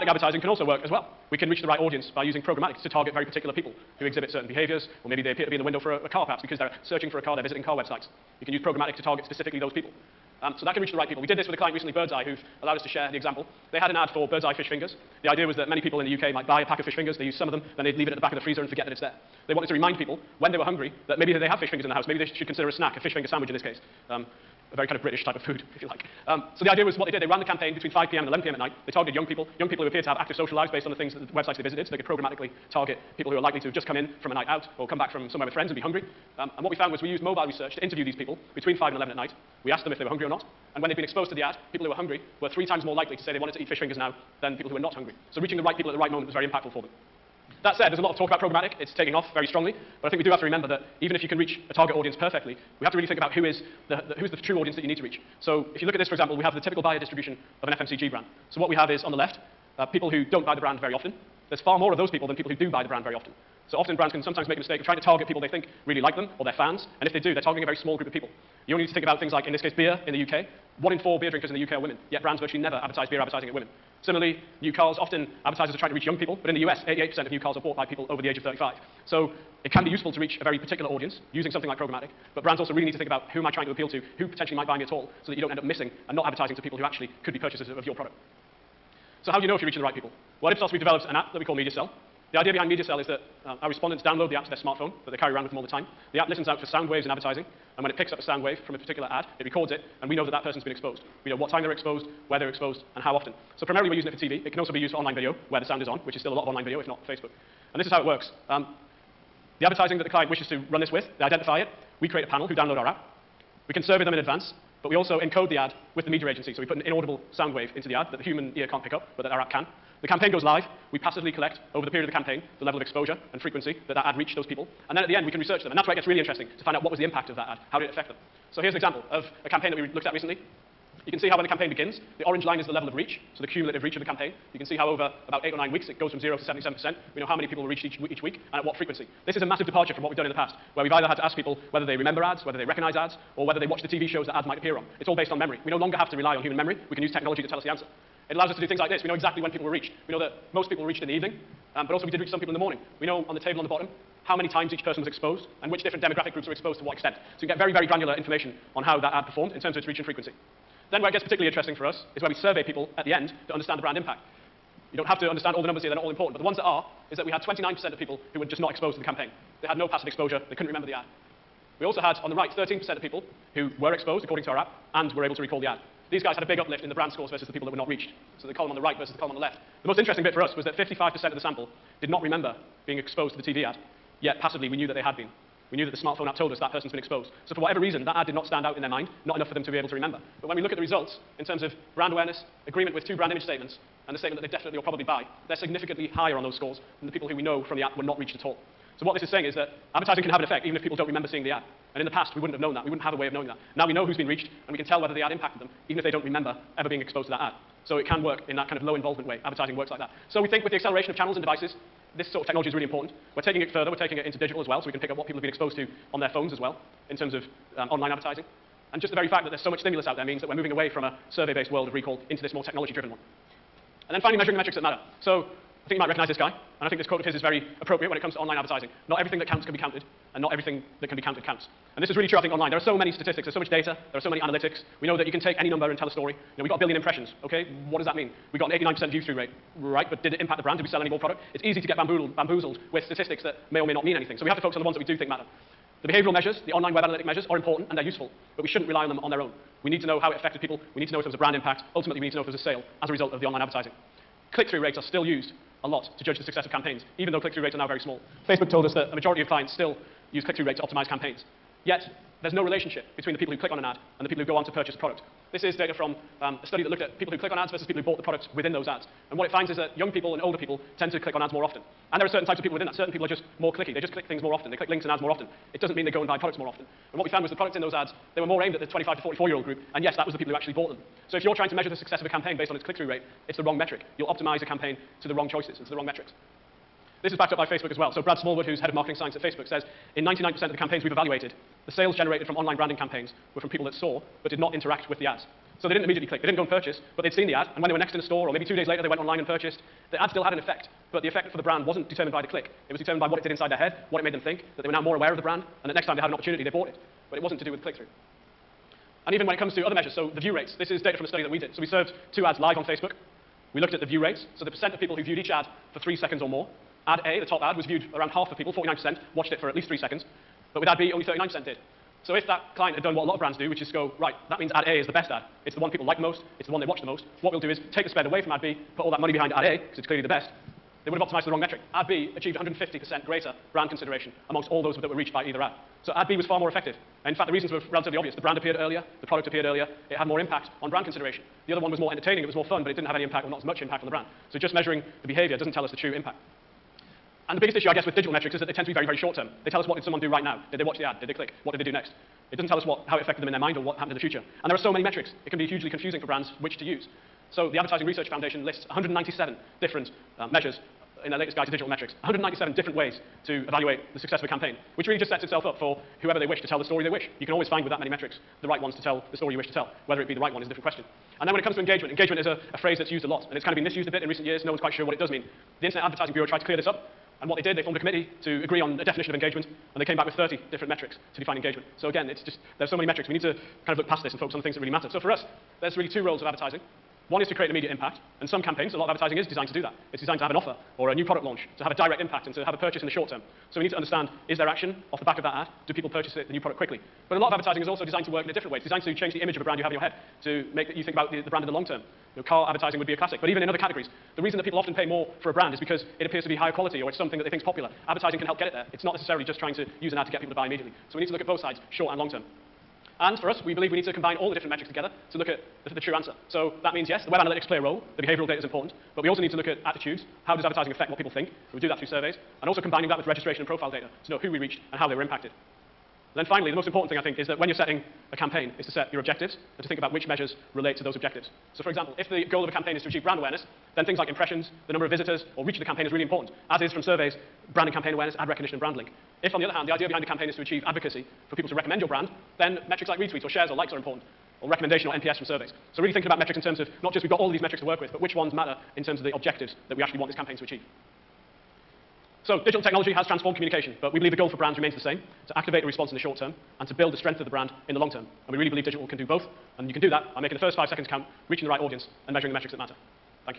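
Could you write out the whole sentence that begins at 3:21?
And in the past, we wouldn't have known that.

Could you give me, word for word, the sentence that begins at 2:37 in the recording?
So you can get very, very granular information on how that ad performed in terms of its reach and frequency.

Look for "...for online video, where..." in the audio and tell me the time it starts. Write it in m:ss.
1:44.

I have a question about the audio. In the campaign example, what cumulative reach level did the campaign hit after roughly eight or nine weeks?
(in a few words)
77%.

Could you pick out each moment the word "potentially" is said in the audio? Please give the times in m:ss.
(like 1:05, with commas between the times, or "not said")
1:24.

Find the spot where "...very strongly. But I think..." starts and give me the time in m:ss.
0:49.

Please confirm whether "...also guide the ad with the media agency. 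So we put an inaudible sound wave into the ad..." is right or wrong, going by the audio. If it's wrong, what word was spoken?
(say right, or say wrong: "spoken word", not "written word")
wrong: "encode", not "guide".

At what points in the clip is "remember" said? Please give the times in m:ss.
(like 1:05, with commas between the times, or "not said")
0:50, 2:21, 2:50, 3:02, 3:09, 3:21, 3:26.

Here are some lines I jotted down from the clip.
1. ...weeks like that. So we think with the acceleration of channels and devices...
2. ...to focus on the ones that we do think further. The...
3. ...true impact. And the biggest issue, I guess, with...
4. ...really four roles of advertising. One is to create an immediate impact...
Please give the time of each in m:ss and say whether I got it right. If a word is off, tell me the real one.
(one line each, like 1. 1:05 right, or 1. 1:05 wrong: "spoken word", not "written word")
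1. 3:29 wrong: "works", not "weeks"
2. 4:04 wrong: "matter", not "further"
3. 5:45 right
4. 6:25 wrong: "two", not "four".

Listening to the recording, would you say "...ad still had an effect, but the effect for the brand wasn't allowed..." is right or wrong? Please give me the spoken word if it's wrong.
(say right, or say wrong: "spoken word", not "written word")
wrong: "determined", not "allowed".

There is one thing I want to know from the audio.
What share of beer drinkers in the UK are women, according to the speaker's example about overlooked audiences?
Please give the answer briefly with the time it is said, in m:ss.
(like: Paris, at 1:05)
One in four, at 1:10.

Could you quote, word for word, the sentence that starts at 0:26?
Um, so the idea was what they did, they ran the campaign between 5 p.m.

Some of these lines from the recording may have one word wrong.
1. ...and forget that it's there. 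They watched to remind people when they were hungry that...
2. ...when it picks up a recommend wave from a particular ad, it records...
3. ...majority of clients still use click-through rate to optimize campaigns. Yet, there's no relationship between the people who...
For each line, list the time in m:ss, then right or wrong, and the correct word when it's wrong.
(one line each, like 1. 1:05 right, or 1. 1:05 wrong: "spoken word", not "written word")
1. 0:18 wrong: "wanted", not "watched"
2. 1:37 wrong: "sound", not "recommend"
3. 4:19 right.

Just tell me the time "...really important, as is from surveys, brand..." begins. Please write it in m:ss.
7:16.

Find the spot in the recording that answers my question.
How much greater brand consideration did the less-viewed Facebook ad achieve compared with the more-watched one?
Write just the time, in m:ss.
5:32.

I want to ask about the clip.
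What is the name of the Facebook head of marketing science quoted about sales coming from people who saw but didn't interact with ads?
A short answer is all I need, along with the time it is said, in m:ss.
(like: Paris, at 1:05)
Brad Smallwood, at 4:48.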